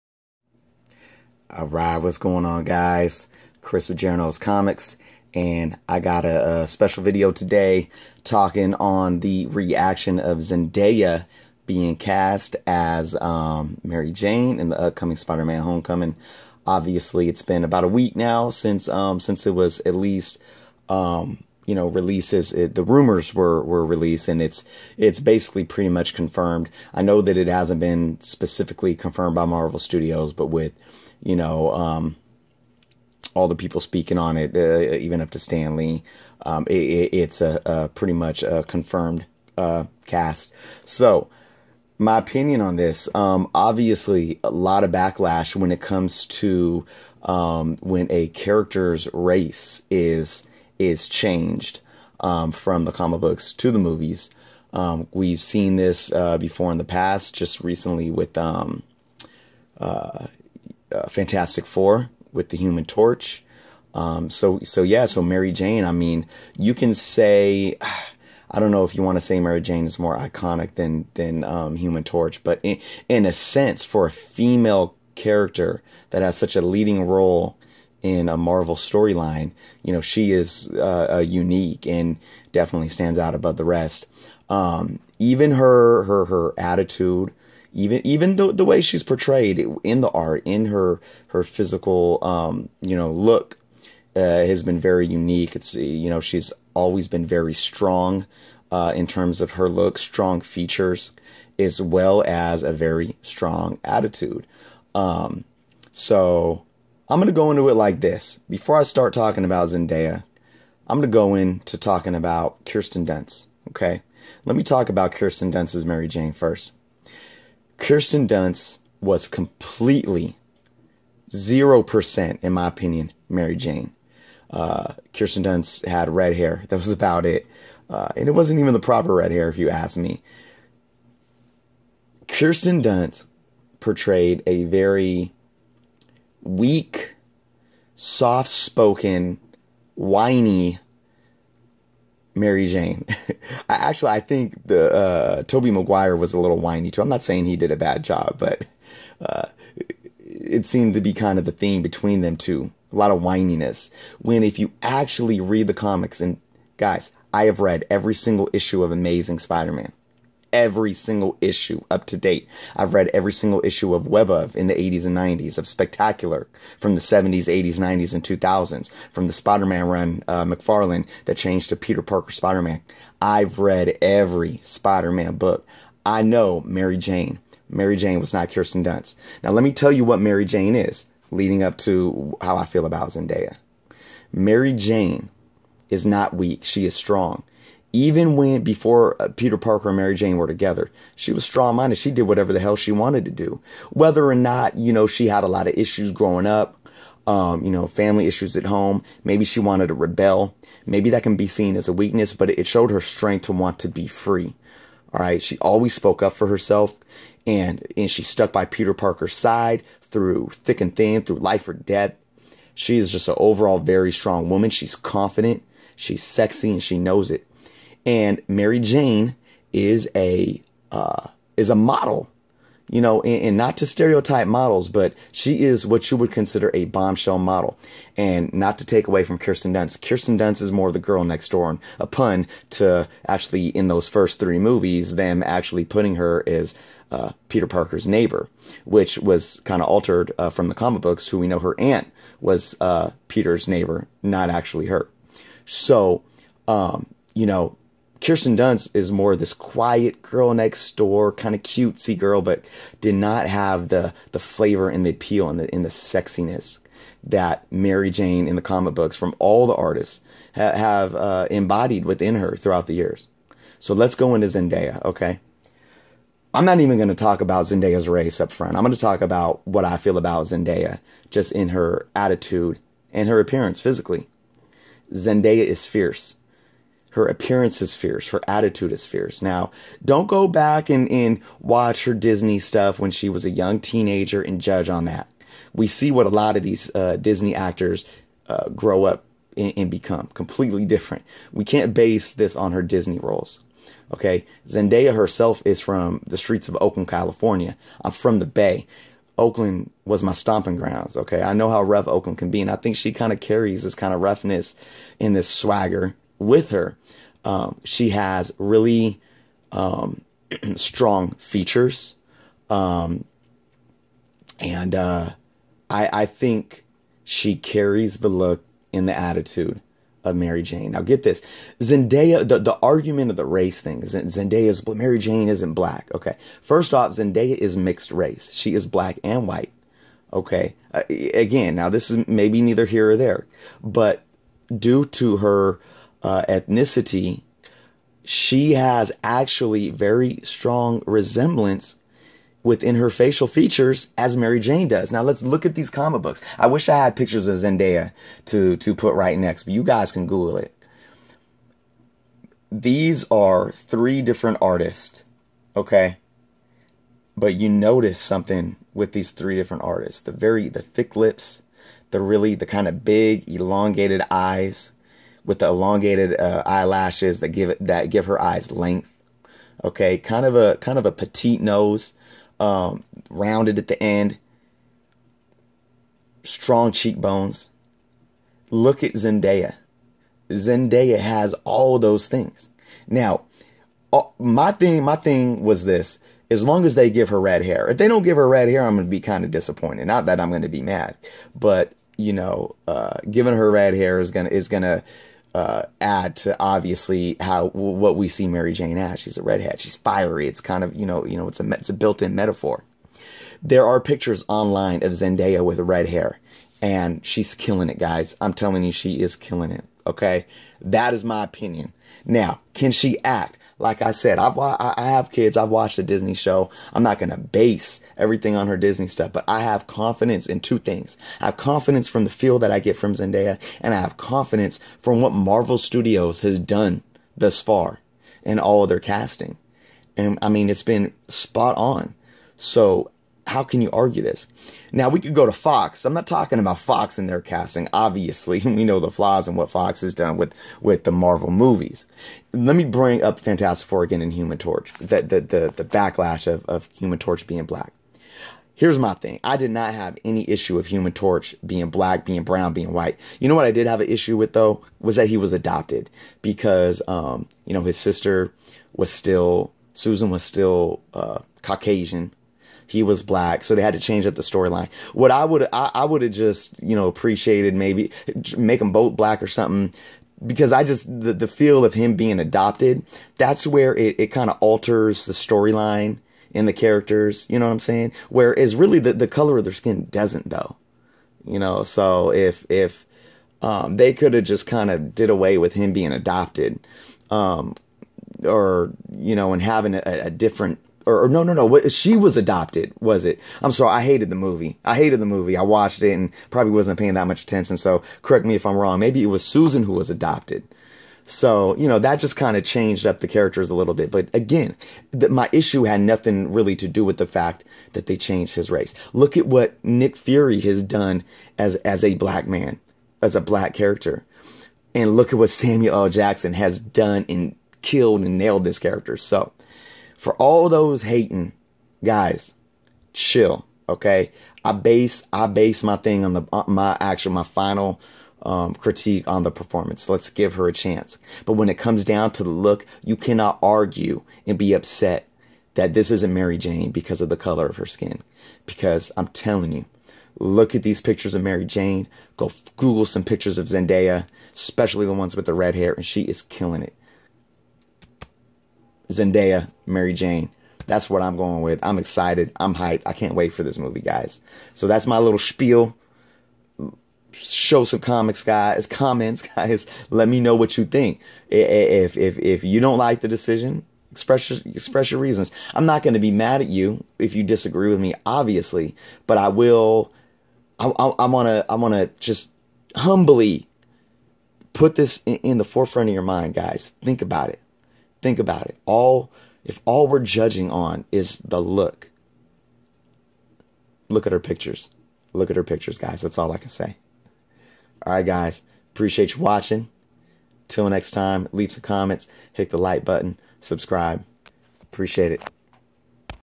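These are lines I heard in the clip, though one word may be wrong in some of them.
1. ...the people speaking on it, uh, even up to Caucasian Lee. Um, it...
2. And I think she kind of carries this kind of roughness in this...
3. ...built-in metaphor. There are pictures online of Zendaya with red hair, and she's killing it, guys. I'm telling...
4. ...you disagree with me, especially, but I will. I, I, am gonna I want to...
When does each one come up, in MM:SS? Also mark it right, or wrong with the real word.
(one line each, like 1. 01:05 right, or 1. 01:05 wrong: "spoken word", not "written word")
1. 00:33 wrong: "Stan", not "Caucasian"
2. 05:02 right
3. 06:41 right
4. 09:27 wrong: "obviously", not "especially".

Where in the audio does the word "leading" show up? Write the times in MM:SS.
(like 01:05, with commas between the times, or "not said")
01:16, 03:01.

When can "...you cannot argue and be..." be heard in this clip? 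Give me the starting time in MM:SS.
08:53.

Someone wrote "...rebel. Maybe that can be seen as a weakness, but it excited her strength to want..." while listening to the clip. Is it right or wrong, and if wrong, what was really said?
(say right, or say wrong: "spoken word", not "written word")
wrong: "showed", not "excited".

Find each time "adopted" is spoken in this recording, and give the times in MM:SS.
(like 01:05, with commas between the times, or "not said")
07:35, 07:52, 08:06, 08:12, 08:20.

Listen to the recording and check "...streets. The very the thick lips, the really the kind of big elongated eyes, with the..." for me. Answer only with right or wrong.
wrong.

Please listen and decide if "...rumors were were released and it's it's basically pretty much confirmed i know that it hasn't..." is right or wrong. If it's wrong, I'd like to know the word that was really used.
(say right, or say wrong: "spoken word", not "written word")
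right.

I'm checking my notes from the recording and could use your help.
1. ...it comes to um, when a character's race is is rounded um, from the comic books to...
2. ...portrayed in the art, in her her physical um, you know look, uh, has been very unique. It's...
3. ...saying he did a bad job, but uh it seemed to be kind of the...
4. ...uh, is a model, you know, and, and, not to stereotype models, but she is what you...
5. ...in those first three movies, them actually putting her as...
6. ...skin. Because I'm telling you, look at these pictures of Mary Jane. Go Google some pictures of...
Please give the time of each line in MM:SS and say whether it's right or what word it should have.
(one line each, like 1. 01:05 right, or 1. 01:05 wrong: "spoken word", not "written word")
1. 00:45 wrong: "changed", not "rounded"
2. 01:29 right
3. 02:27 right
4. 03:40 right
5. 03:53 right
6. 08:57 right.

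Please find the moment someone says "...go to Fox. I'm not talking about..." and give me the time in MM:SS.
07:15.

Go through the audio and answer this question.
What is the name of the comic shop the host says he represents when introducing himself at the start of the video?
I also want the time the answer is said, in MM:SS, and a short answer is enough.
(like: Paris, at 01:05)
Jerno's Comics, at 00:03.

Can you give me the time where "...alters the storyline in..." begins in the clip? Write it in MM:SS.
07:54.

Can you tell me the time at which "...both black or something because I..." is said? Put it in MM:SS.
07:48.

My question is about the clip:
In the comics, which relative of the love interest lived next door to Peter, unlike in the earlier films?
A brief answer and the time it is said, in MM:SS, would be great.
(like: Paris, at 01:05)
Her aunt, at 04:01.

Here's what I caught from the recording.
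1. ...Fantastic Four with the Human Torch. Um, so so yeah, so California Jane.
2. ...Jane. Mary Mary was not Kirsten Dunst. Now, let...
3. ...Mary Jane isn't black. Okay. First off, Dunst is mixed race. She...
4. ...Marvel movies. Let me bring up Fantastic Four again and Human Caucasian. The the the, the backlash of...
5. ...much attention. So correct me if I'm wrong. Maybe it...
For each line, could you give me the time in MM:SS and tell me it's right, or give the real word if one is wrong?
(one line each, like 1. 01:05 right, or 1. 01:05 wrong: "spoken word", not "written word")
1. 01:01 wrong: "Mary", not "California"
2. 02:56 wrong: "Jane", not "Mary"
3. 05:24 wrong: "Zendaya", not "Dunst"
4. 07:21 wrong: "Torch", not "Caucasian"
5. 08:17 right.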